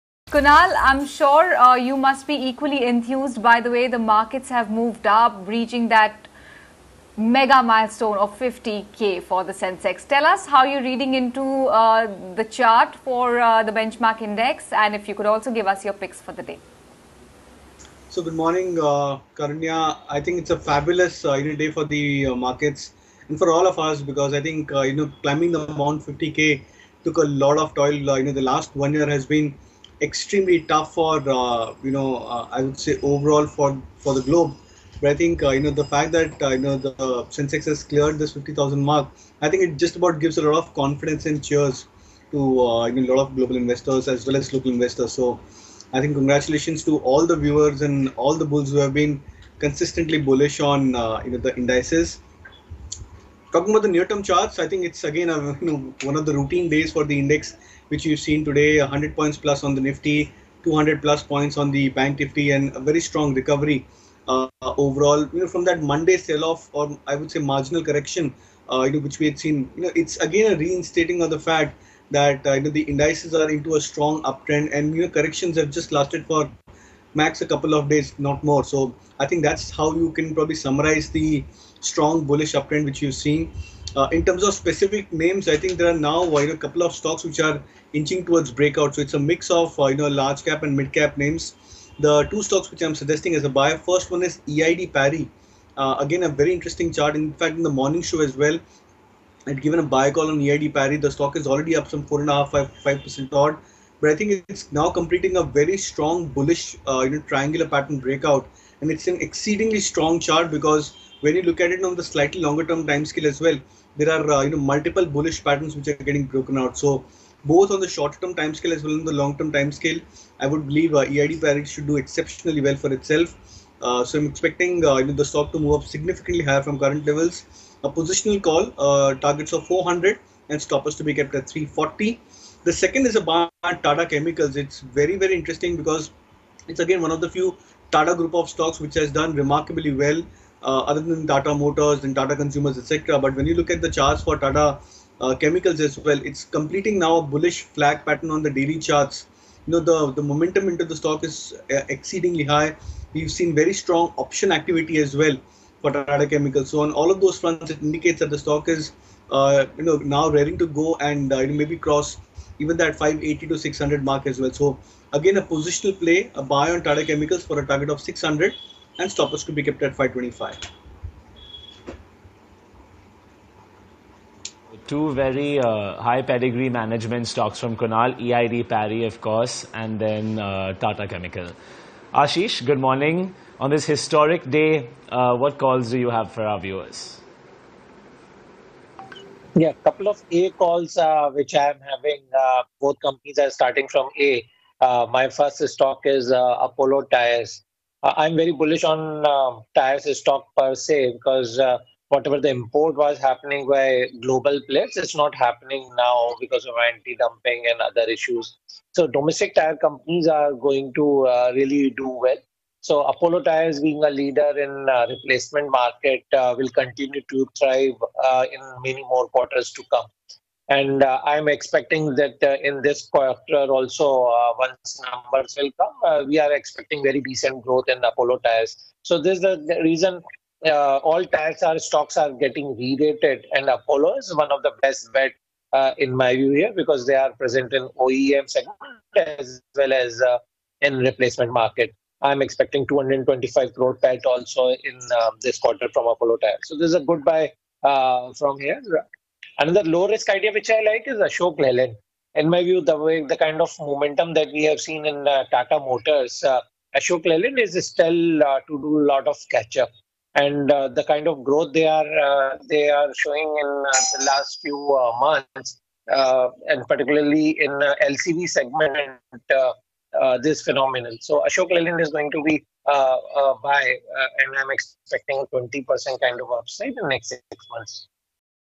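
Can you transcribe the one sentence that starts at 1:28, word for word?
So it's a mix of uh, you know large cap and mid cap names.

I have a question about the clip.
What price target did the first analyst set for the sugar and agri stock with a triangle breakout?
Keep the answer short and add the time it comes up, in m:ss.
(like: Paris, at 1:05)
400, at 2:09.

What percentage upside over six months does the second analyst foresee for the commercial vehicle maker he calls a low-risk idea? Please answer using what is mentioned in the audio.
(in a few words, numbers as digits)
20%.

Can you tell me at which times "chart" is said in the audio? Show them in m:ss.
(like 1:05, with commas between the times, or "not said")
0:12, 0:54, 1:36, 1:50, 2:23, 2:28.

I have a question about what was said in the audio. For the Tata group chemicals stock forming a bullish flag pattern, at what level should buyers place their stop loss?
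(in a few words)
525.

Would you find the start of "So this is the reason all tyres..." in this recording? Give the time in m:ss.
3:49.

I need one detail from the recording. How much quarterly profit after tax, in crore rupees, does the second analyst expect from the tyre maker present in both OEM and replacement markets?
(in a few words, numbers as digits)
225 crore.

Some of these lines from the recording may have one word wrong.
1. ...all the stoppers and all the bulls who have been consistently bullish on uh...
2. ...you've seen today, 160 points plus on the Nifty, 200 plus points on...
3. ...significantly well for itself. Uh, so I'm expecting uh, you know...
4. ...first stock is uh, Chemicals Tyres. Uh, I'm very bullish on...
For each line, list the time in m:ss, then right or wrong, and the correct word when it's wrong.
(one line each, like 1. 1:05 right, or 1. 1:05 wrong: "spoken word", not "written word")
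1. 0:46 wrong: "viewers", not "stoppers"
2. 0:58 wrong: "100", not "160"
3. 2:01 wrong: "exceptionally", not "significantly"
4. 3:15 wrong: "Apollo", not "Chemicals".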